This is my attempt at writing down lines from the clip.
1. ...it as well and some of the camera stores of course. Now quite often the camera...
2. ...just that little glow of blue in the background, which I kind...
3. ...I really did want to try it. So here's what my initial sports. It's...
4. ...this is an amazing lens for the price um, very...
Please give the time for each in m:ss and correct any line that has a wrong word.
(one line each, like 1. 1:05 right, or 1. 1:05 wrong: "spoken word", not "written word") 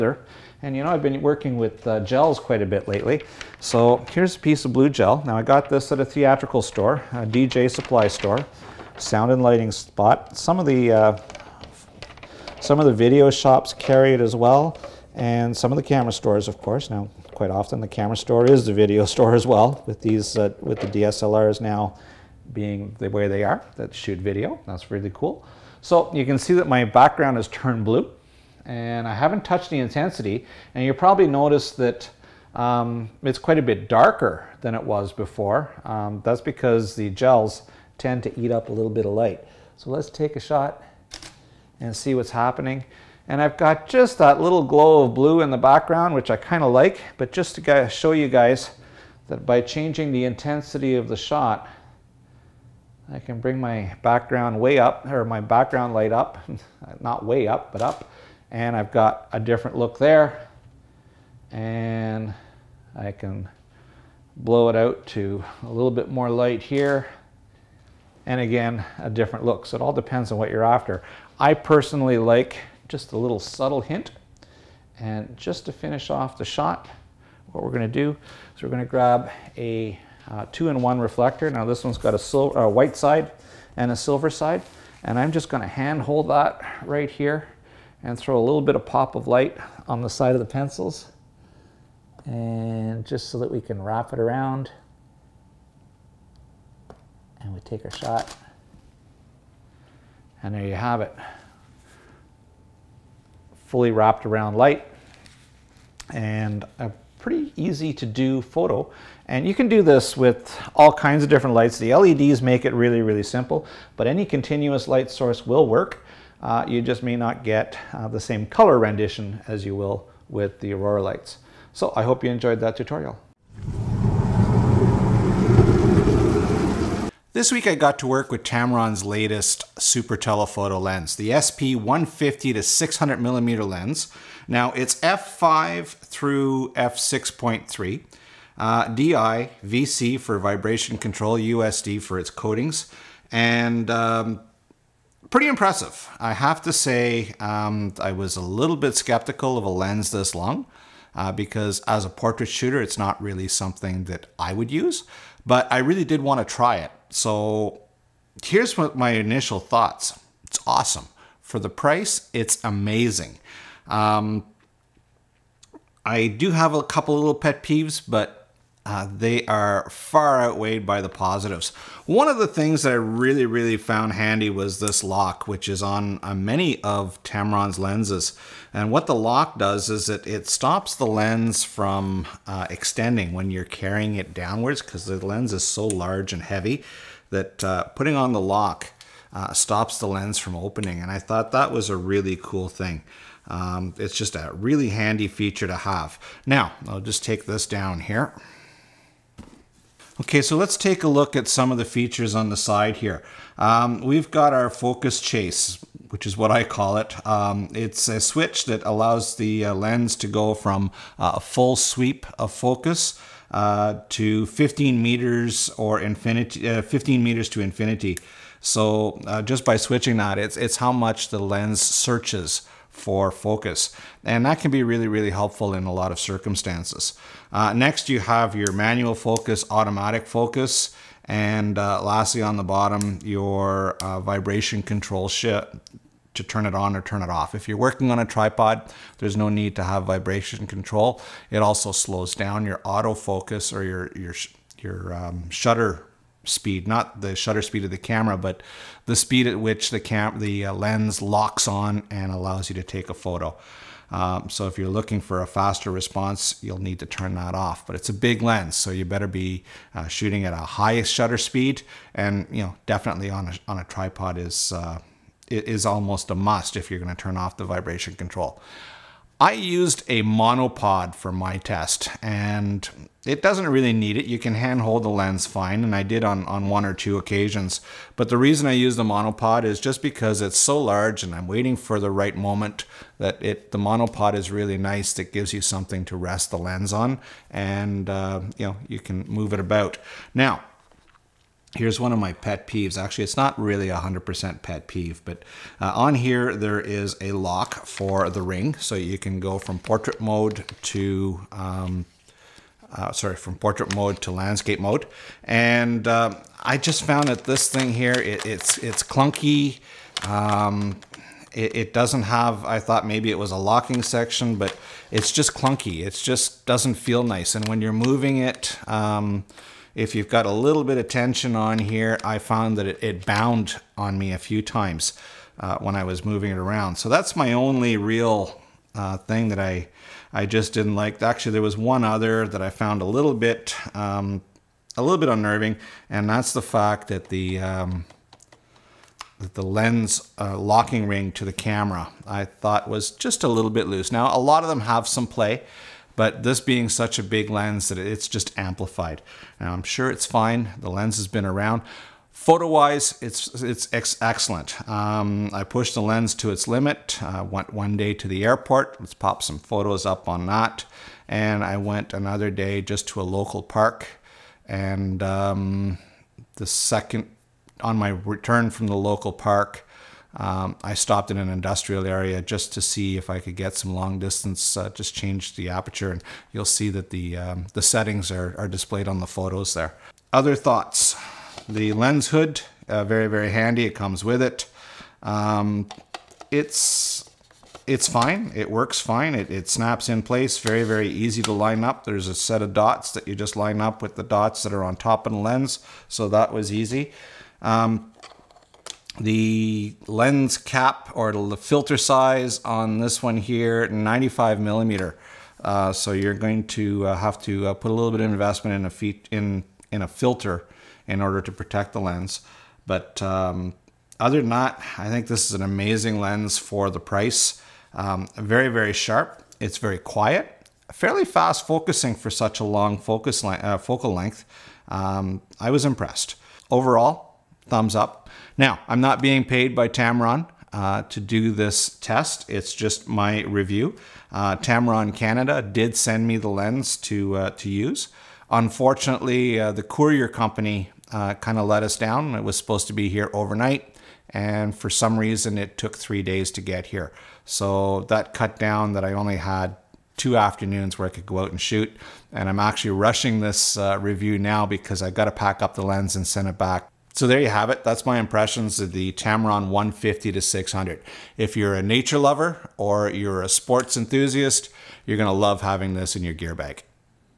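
1. 0:14 right
2. 0:43 right
3. 2:35 wrong: "thoughts", not "sports"
4. 6:55 right.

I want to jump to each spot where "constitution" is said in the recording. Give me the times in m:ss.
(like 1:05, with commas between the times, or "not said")
not said.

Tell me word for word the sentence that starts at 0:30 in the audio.
And you probably notice that um, it's quite a bit darker than it was before.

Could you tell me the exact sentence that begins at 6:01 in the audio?
And I went another day just to a local park.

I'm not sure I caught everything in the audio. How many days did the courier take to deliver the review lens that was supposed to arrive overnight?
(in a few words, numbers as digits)
3.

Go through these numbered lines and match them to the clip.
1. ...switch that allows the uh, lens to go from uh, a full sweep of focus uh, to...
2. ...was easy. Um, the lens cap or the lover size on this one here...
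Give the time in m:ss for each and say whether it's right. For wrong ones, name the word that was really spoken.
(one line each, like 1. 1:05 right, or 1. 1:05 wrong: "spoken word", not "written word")
1. 3:28 right
2. 6:36 wrong: "filter", not "lover".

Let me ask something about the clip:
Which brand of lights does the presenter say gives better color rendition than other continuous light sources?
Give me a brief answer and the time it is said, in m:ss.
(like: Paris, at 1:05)
Aurora, at 2:00.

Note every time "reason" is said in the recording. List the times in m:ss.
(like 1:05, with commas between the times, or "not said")
4:38, 7:25.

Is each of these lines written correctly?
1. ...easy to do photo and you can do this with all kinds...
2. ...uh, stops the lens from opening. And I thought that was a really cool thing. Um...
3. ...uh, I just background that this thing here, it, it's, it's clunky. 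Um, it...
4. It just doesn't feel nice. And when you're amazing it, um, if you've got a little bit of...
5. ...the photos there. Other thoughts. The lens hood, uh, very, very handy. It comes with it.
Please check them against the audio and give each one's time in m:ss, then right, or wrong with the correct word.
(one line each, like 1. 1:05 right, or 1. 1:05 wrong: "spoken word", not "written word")
1. 1:47 right
2. 3:09 right
3. 5:06 wrong: "found", not "background"
4. 5:16 wrong: "moving", not "amazing"
5. 6:19 right.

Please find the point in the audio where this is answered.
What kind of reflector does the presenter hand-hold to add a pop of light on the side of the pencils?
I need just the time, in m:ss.
1:20.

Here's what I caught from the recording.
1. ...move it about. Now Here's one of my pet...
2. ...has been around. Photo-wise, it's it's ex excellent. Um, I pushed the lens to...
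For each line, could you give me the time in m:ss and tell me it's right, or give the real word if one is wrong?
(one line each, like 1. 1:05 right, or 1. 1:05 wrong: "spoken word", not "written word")
1. 4:49 right
2. 5:51 right.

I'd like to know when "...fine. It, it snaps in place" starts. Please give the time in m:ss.
6:28.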